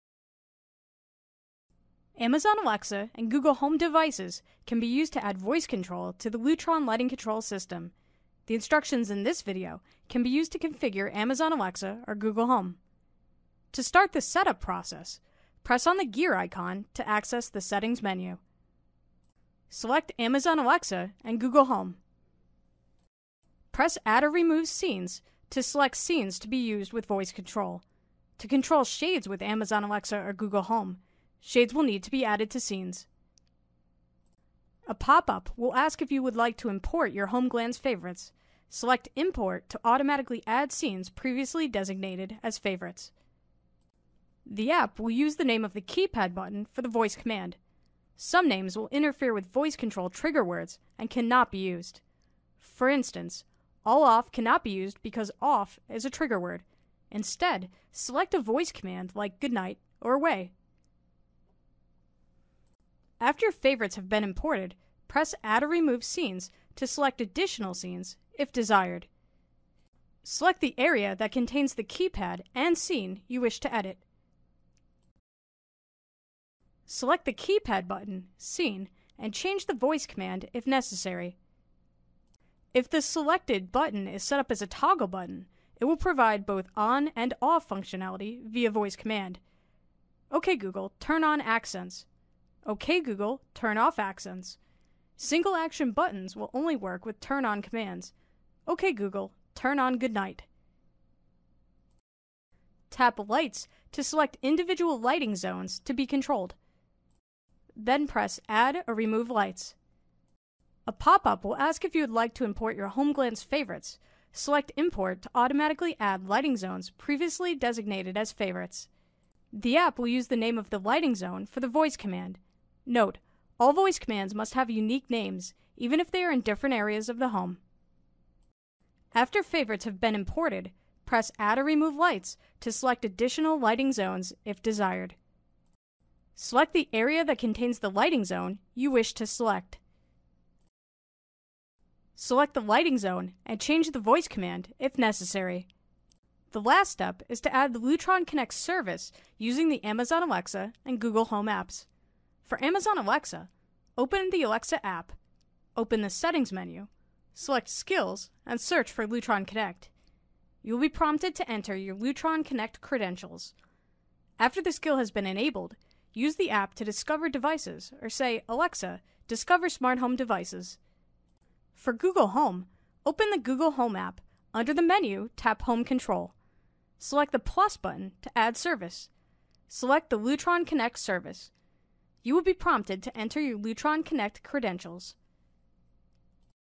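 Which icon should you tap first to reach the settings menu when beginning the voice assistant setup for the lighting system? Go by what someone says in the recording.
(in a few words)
gear icon.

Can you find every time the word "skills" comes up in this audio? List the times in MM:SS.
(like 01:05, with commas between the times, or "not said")
02:37, 02:44.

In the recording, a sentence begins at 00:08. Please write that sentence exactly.
The instructions in this video can be used to configure Amazon Alexa or Google Home.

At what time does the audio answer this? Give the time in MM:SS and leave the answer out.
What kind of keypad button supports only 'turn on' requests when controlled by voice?
01:35.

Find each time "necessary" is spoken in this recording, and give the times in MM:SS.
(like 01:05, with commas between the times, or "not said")
01:20, 02:24.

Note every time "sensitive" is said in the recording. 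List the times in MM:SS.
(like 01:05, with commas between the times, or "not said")
not said.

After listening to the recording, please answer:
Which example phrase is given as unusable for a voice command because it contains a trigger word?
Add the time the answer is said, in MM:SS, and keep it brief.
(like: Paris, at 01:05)
all off, at 00:53.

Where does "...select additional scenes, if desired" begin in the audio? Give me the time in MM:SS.
01:06.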